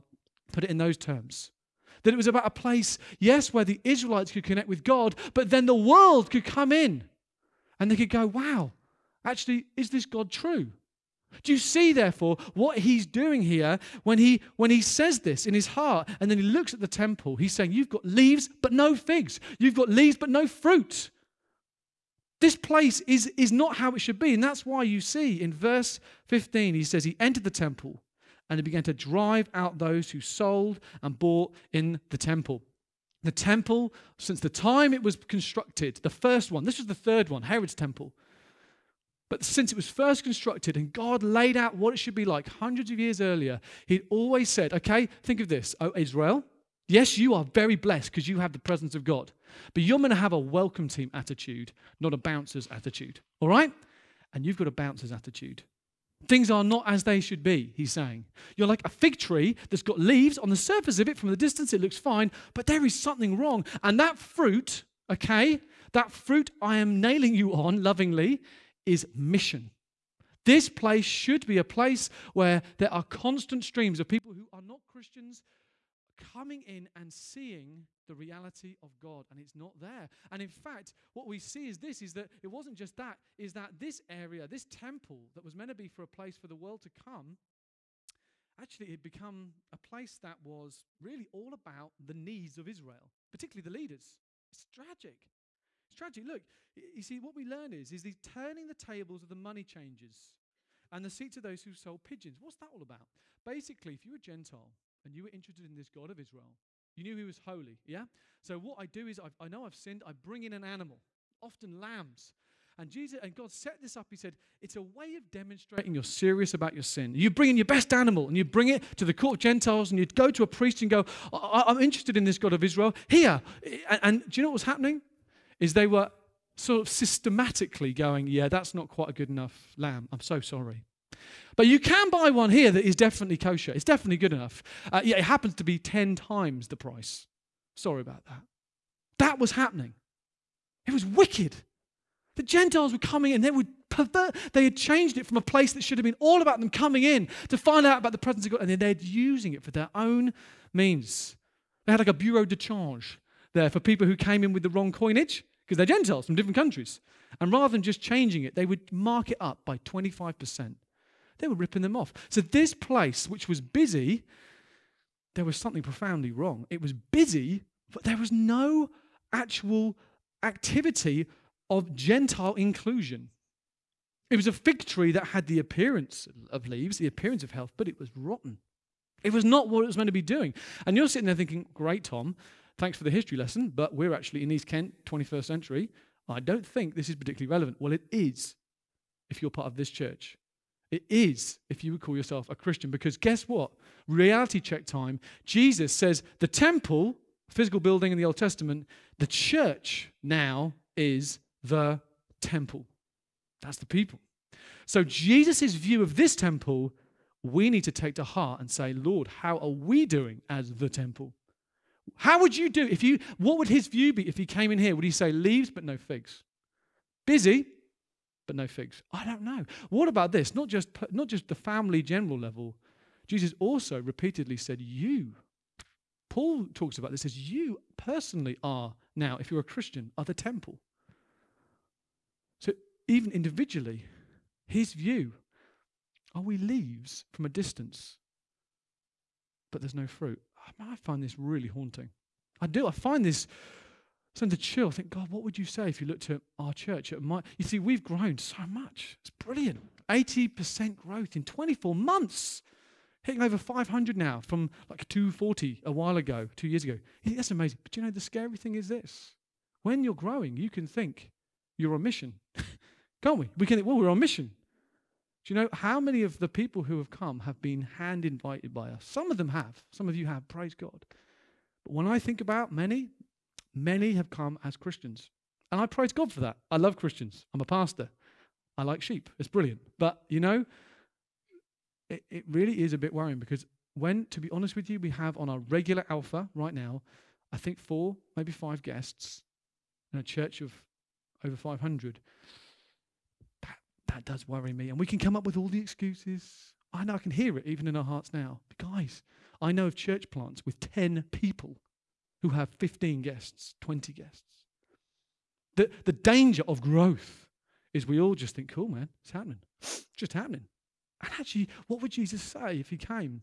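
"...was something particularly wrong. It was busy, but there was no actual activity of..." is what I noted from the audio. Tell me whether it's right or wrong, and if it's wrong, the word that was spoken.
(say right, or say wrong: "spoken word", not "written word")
wrong: "profoundly", not "particularly".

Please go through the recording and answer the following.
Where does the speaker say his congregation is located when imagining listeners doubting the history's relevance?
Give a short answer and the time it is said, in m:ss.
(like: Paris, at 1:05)
East Kent, at 3:04.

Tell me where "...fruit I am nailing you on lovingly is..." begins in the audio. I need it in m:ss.
1:06.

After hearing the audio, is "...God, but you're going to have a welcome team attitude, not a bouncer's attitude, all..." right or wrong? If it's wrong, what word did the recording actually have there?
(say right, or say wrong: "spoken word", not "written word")
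right.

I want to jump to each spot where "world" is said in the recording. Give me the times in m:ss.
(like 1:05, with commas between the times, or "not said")
0:05, 1:26.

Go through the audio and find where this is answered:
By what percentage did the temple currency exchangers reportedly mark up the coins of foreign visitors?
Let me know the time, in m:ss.
2:39.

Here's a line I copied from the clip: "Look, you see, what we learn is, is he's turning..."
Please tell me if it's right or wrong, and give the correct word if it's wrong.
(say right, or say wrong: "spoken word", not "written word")
right.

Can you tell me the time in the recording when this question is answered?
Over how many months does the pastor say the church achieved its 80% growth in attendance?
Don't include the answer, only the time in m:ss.
4:11.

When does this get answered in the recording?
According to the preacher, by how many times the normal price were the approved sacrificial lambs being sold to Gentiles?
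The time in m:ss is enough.
2:15.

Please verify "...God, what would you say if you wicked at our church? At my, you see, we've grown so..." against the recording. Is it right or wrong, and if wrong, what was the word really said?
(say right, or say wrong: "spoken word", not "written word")
wrong: "looked", not "wicked".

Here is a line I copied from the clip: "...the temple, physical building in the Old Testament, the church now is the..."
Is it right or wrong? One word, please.
right.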